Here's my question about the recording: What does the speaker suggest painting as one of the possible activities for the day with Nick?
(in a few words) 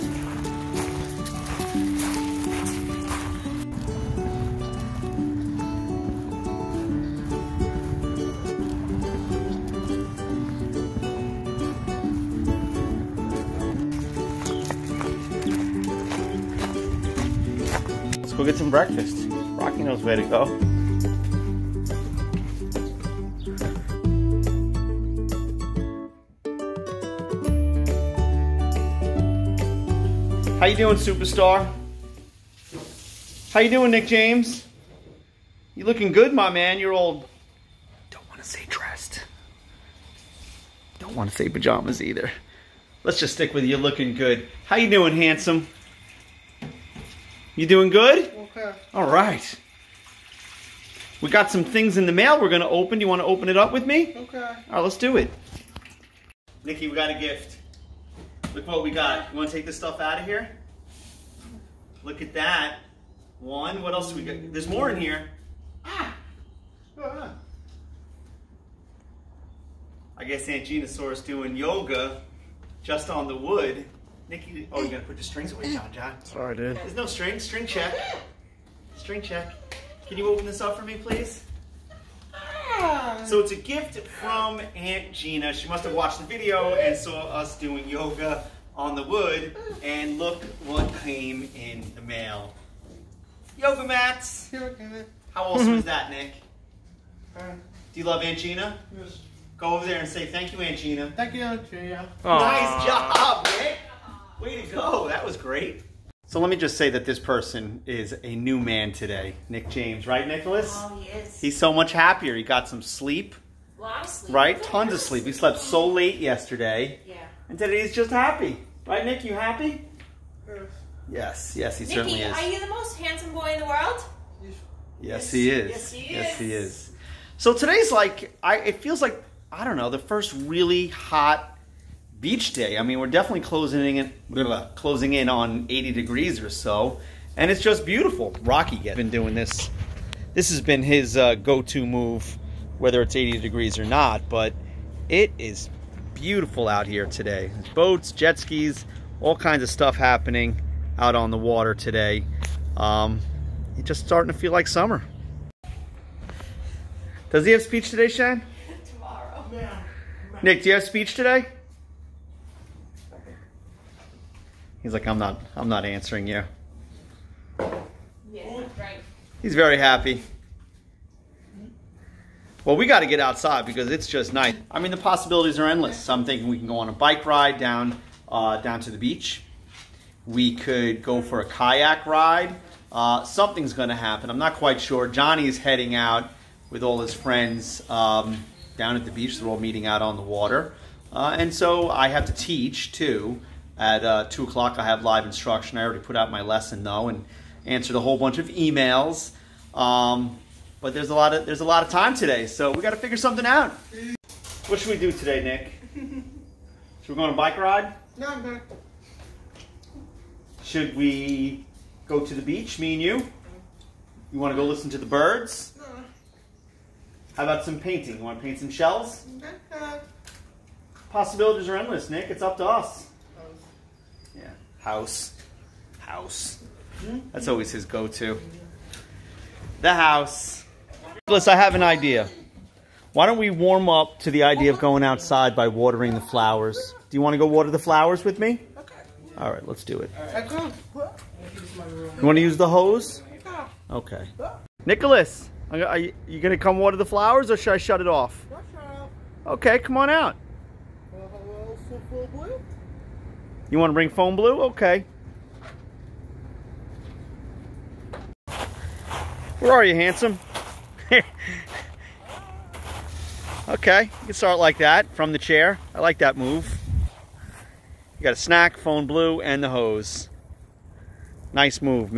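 Shells.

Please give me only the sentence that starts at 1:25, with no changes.
She must have watched the video and saw us doing yoga on the wood.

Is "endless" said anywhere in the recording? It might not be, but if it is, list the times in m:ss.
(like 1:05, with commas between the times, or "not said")
2:55, 3:41.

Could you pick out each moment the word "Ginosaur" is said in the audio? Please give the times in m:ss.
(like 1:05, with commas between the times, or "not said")
1:10.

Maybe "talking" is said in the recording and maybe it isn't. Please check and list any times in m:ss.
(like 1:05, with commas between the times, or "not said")
not said.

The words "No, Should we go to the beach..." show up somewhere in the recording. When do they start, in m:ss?
3:28.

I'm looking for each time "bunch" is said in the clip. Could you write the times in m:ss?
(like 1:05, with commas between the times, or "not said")
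3:18.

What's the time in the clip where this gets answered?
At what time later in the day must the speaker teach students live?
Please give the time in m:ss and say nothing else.
3:14.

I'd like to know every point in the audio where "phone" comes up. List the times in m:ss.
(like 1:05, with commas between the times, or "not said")
4:14, 4:28.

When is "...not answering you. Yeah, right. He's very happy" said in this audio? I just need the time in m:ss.
2:45.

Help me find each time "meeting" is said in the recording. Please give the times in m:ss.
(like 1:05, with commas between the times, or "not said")
3:09.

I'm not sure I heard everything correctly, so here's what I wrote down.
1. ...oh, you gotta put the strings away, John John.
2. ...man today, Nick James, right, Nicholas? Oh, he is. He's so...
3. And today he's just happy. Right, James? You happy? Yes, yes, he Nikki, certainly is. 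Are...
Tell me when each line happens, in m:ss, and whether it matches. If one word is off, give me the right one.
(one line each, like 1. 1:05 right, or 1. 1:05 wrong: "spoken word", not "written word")
1. 1:14 right
2. 1:48 right
3. 1:57 wrong: "Nick", not "James".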